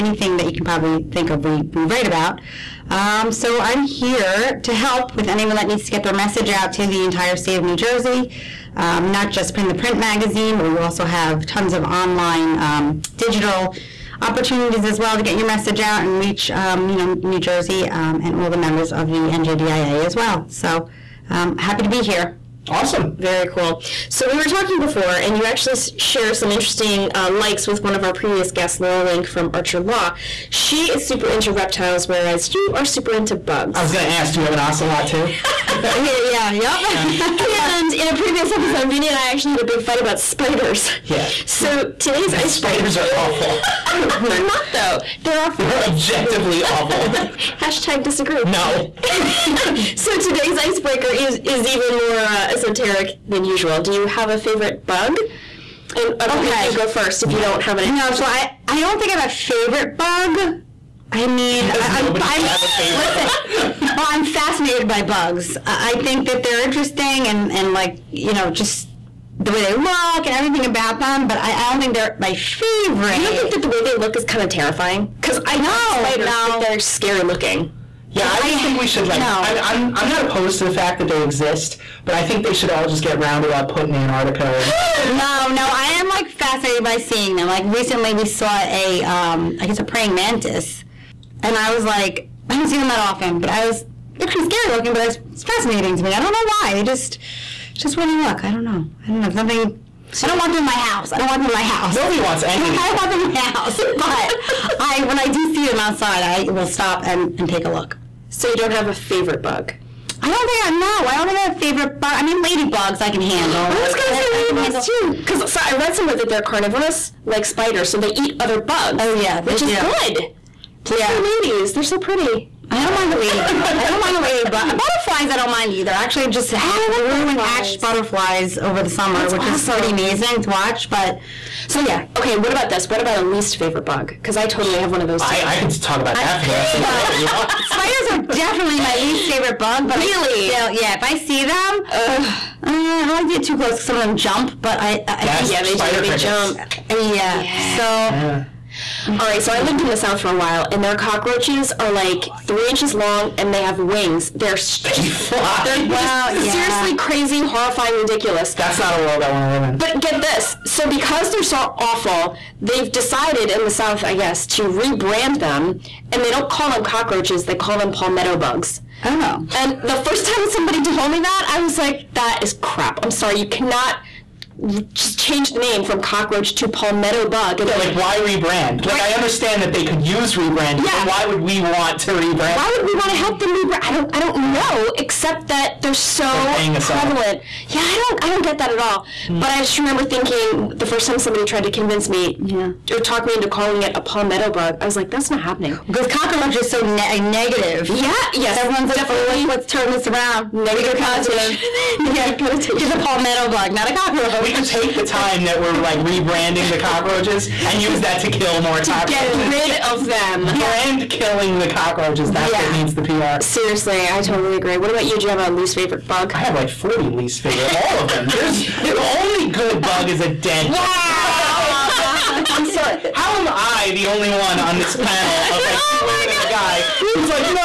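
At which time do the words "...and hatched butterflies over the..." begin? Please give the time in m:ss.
2:07.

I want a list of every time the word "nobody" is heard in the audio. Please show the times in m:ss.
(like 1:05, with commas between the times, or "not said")
1:02, 1:41.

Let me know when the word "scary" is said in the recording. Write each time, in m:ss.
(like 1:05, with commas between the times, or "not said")
1:16, 1:34.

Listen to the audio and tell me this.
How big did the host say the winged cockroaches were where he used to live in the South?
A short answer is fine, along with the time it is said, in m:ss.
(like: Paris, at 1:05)
3 inches, at 2:32.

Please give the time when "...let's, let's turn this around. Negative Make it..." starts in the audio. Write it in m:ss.
3:19.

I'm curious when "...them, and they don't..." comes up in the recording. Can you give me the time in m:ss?
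2:45.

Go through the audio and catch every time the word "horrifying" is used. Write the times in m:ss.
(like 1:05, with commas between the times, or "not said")
2:37.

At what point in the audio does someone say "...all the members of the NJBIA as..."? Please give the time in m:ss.
0:18.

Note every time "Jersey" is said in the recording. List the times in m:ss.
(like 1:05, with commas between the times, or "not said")
0:07, 0:17.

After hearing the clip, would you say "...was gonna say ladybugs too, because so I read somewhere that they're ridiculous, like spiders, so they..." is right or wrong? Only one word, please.
wrong.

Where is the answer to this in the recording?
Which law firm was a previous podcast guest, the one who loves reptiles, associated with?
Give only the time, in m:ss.
0:29.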